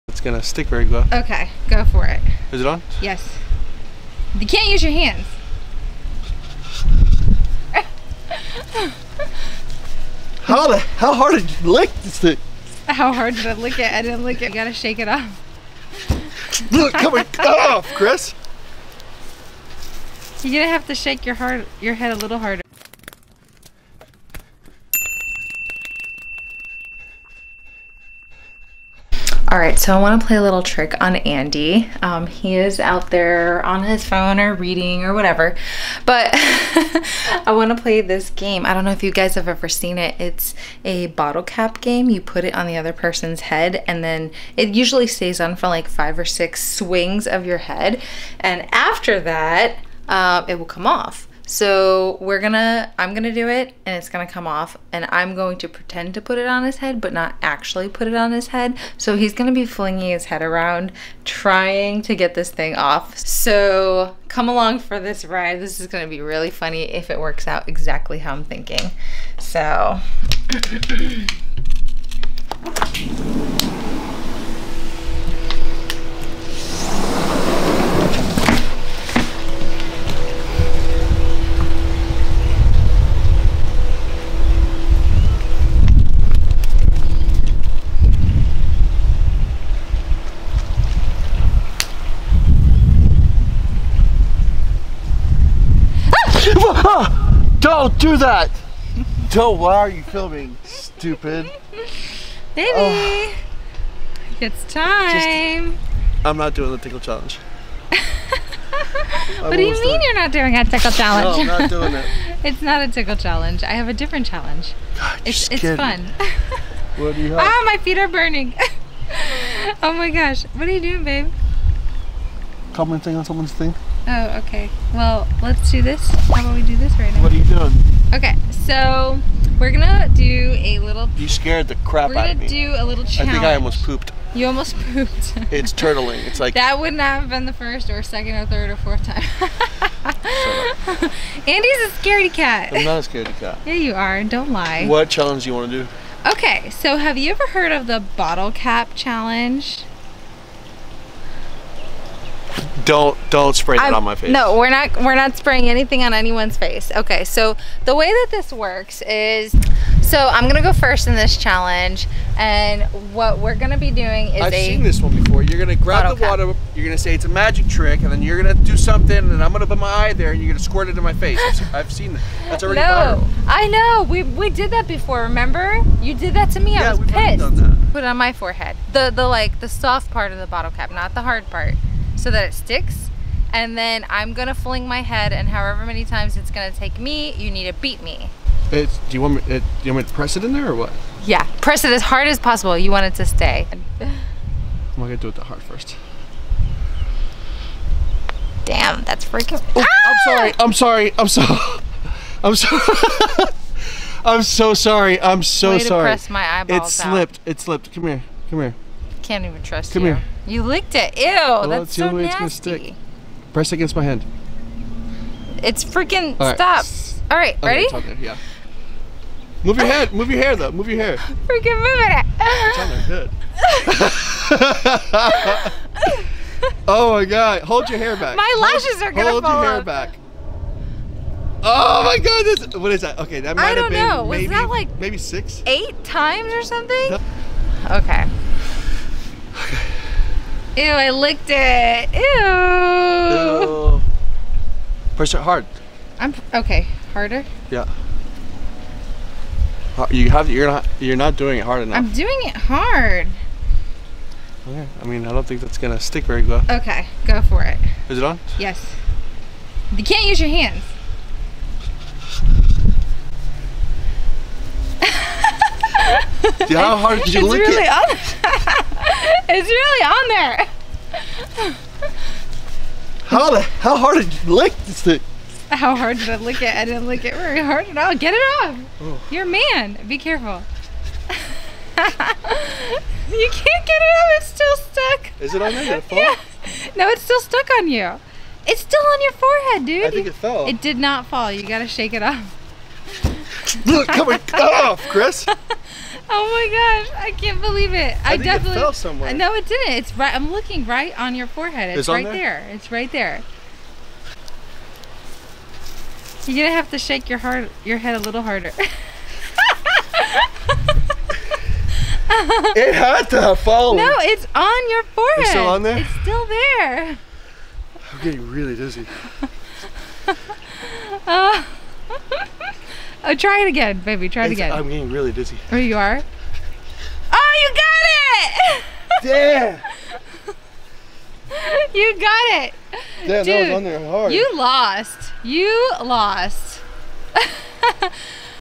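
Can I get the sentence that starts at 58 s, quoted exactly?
So he's gonna be flinging his head around trying to get this thing off.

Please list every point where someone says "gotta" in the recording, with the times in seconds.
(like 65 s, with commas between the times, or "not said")
14 s, 291 s.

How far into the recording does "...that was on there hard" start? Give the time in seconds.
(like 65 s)
333 s.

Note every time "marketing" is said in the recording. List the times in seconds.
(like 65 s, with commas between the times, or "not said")
not said.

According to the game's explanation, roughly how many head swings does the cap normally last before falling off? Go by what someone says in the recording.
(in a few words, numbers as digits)
5 or 6.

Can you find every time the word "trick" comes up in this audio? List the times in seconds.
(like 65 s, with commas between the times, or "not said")
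30 s, 167 s.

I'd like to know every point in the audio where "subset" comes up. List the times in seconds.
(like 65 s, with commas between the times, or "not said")
not said.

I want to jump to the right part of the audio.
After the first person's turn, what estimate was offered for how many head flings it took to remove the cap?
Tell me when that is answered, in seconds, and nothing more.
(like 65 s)
235 s.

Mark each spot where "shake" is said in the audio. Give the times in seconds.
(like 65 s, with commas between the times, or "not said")
14 s, 20 s, 291 s, 306 s.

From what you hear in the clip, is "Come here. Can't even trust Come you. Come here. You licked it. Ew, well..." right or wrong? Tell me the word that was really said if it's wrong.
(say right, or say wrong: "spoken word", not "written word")
right.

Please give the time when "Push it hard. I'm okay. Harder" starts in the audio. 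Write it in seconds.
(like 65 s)
245 s.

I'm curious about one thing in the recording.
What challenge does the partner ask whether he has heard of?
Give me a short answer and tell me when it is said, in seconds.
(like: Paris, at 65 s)
bottle cap challenge, at 148 s.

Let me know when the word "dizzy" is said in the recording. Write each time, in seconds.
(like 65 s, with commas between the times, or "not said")
318 s, 325 s.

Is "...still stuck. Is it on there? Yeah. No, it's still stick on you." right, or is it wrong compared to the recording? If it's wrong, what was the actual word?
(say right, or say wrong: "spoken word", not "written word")
wrong: "stuck", not "stick".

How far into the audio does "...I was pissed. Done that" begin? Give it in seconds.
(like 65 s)
176 s.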